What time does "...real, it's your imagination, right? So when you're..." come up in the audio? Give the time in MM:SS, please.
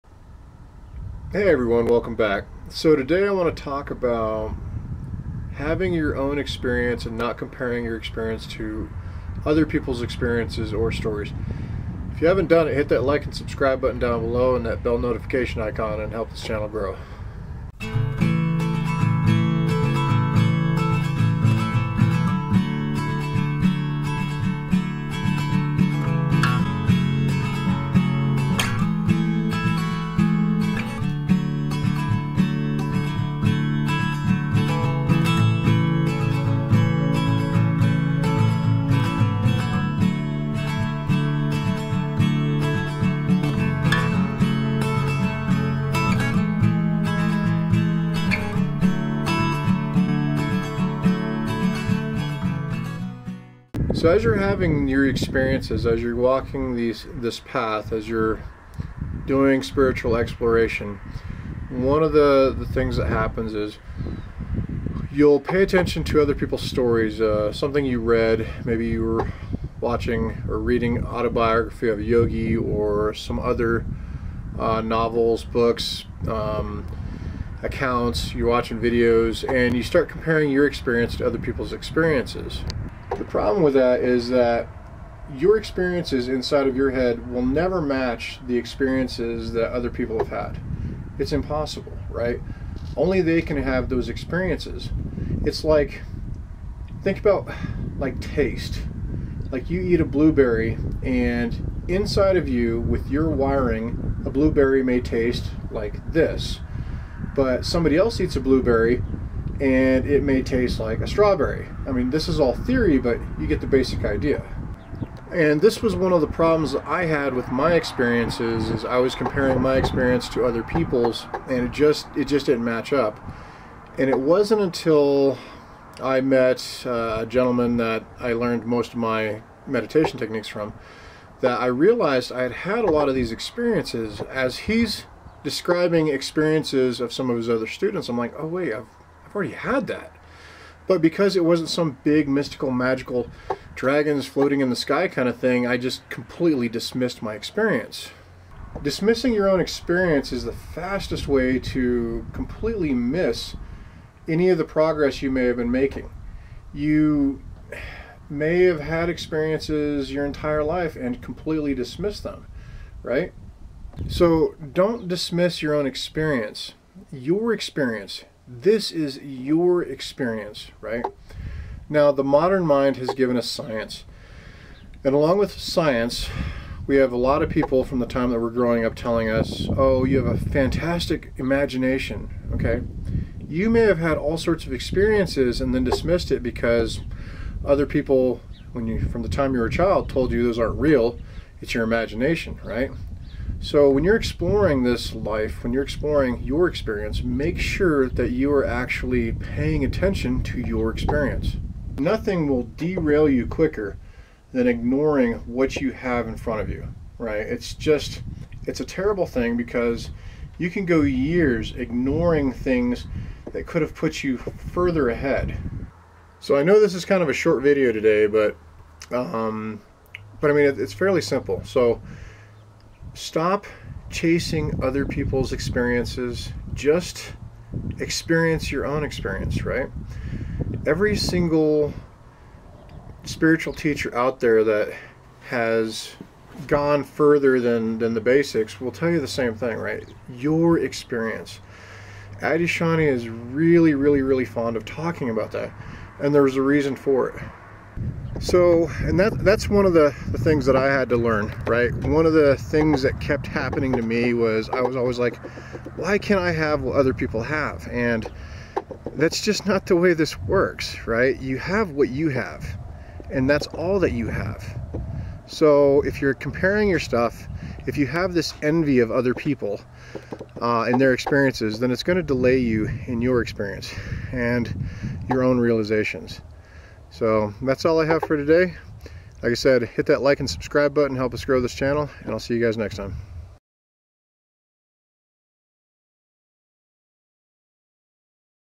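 03:10.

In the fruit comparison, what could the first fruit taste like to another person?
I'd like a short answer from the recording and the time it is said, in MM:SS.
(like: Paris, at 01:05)
Strawberry, at 01:51.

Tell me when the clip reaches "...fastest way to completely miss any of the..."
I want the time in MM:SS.
02:30.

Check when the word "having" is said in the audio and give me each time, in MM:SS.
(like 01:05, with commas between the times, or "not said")
00:05, 00:54.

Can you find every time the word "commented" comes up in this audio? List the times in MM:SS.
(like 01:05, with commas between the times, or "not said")
not said.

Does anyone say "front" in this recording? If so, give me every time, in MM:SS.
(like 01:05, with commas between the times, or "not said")
03:26.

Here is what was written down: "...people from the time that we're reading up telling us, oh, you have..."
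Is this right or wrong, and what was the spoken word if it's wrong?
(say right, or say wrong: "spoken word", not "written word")
wrong: "growing", not "reading".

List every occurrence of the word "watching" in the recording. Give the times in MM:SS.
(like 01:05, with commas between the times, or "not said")
01:09, 01:18.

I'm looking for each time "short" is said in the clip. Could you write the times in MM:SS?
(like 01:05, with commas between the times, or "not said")
03:37.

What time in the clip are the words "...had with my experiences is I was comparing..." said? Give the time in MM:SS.
01:57.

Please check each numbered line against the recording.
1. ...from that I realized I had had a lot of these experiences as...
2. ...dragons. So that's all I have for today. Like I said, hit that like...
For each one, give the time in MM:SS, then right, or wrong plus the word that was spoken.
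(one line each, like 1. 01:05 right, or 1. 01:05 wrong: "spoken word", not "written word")
1. 02:10 right
2. 04:35 wrong: "realizations", not "dragons".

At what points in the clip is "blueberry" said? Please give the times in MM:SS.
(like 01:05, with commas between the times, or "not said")
01:40, 01:44, 01:48.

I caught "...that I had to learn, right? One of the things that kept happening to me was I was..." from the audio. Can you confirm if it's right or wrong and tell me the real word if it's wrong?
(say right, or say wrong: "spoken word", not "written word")
right.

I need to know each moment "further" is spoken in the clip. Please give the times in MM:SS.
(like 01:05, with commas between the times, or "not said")
03:34, 03:57.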